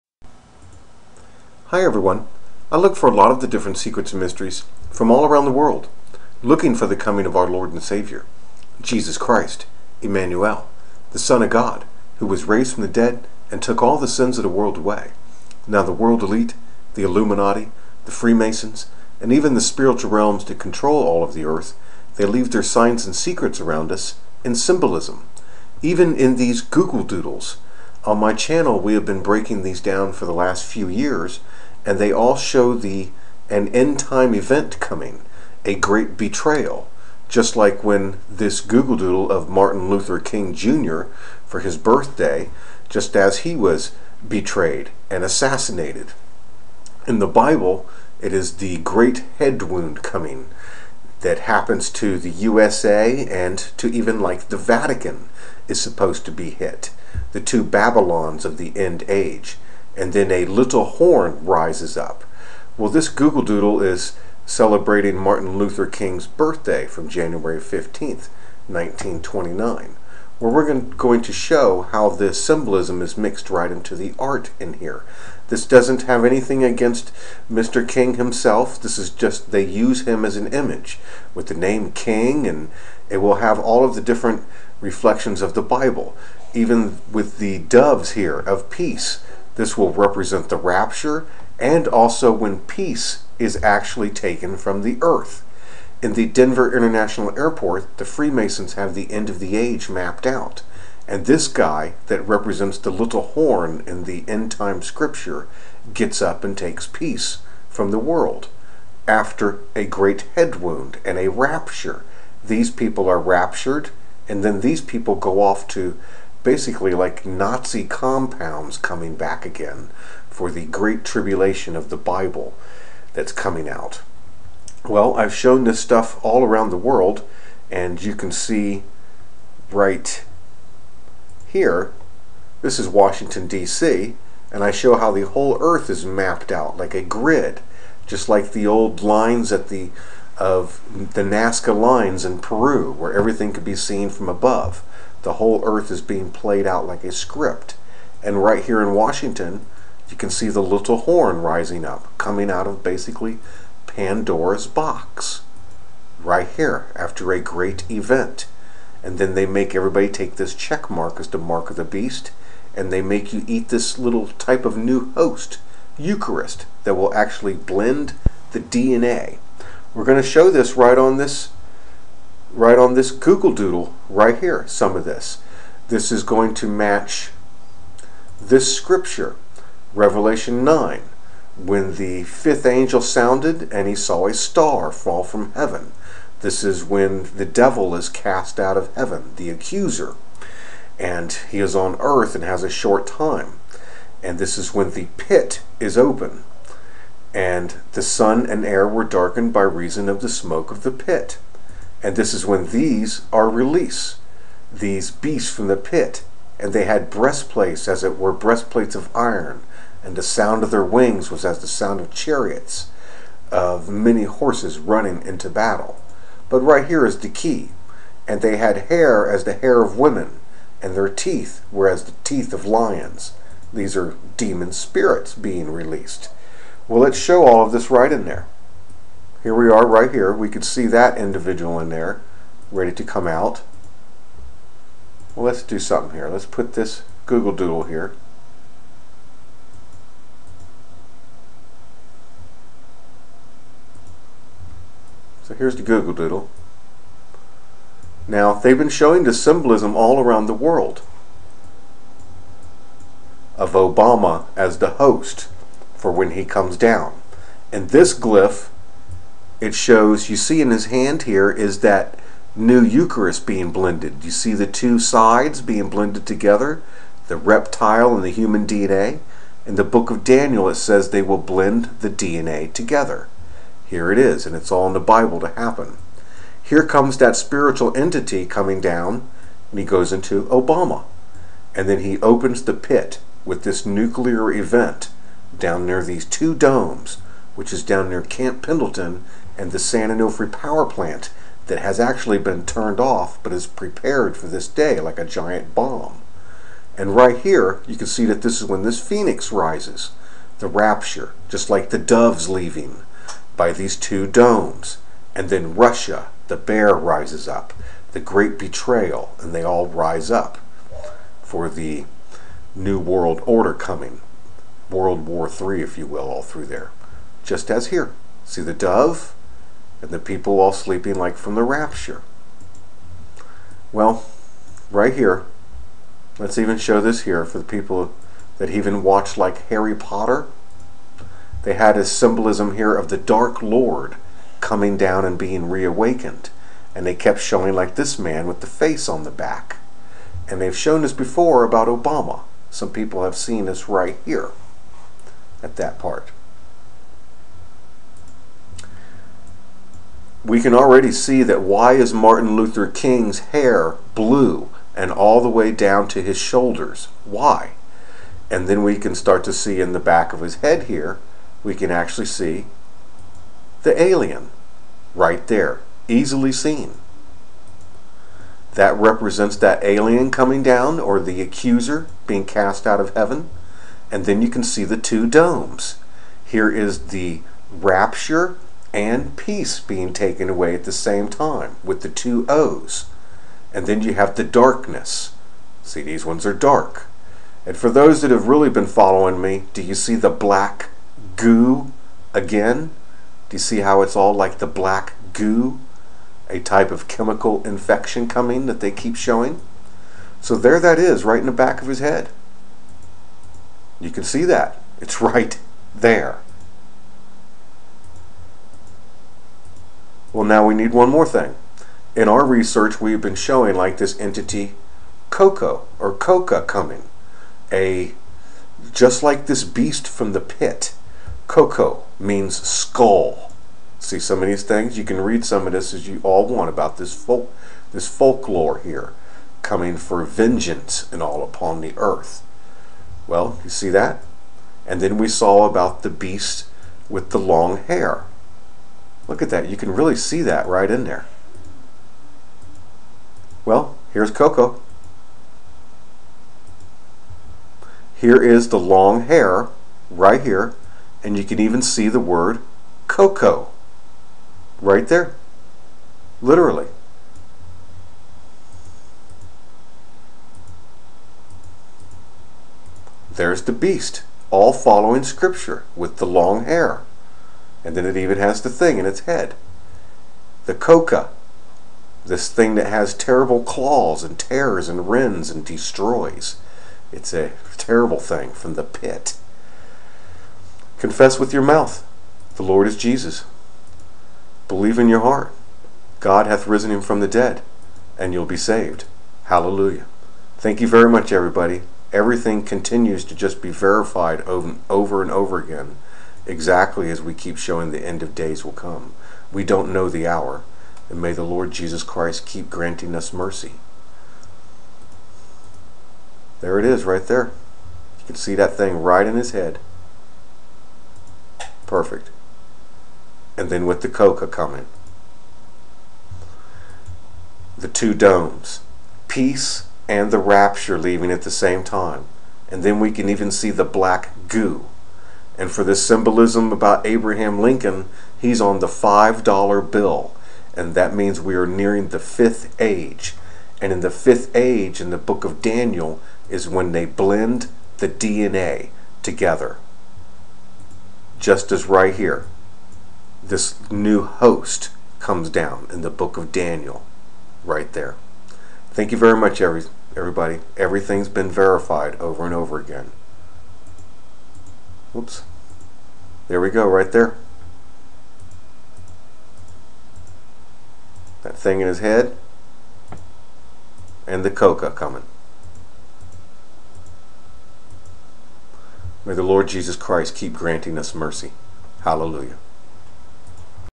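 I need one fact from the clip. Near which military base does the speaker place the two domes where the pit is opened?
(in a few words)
Camp Pendleton.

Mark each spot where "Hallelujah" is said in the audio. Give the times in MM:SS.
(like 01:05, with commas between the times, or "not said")
08:09, 09:32.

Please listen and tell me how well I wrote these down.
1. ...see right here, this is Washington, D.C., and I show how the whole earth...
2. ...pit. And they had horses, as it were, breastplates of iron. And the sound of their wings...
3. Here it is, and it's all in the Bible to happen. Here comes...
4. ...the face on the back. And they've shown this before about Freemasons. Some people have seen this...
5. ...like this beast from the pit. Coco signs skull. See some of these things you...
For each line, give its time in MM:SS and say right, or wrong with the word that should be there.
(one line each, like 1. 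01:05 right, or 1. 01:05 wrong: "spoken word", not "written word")
1. 02:08 right
2. 03:25 wrong: "breastplates", not "horses"
3. 04:33 right
4. 05:38 wrong: "Obama", not "Freemasons"
5. 06:59 wrong: "means", not "signs".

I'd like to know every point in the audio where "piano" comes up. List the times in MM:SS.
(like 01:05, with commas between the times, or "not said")
not said.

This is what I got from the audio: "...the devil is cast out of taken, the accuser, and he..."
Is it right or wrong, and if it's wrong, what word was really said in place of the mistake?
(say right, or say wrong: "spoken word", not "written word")
wrong: "heaven", not "taken".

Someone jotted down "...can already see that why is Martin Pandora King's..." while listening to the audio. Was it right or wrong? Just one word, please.
wrong.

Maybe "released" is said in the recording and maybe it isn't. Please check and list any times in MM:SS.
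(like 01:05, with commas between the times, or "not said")
03:23, 03:45.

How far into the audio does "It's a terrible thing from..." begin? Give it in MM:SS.
07:57.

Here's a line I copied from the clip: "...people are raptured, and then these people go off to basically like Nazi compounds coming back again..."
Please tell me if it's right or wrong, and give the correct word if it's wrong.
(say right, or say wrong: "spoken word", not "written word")
right.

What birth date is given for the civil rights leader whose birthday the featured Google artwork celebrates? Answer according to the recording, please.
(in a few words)
January 15th, 1929.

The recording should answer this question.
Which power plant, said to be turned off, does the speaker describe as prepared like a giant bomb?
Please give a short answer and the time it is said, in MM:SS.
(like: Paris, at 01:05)
San Onofre, at 04:49.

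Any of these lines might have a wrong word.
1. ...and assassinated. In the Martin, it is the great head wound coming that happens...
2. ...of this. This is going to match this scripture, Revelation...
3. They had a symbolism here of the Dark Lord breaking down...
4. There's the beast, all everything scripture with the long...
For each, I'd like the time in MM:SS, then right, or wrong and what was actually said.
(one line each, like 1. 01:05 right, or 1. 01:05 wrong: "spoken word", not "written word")
1. 00:45 wrong: "Bible", not "Martin"
2. 02:54 right
3. 05:31 wrong: "coming", not "breaking"
4. 07:43 wrong: "following", not "everything".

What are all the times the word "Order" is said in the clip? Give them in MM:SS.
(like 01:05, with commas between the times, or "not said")
05:13.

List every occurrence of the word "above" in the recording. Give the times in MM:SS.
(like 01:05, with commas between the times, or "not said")
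02:24.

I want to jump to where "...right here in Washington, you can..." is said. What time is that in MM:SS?
02:28.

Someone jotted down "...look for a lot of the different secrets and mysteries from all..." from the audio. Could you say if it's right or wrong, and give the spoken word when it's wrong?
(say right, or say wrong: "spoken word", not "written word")
right.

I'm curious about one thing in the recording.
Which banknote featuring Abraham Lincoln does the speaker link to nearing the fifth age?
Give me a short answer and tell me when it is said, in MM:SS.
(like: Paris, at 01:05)
$5 bill, at 08:48.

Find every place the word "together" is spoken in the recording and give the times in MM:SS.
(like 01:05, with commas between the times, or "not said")
04:26, 04:32, 08:59.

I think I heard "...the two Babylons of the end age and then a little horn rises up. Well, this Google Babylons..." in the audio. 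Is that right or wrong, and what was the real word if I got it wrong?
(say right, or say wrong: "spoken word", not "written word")
wrong: "Doodle", not "Babylons".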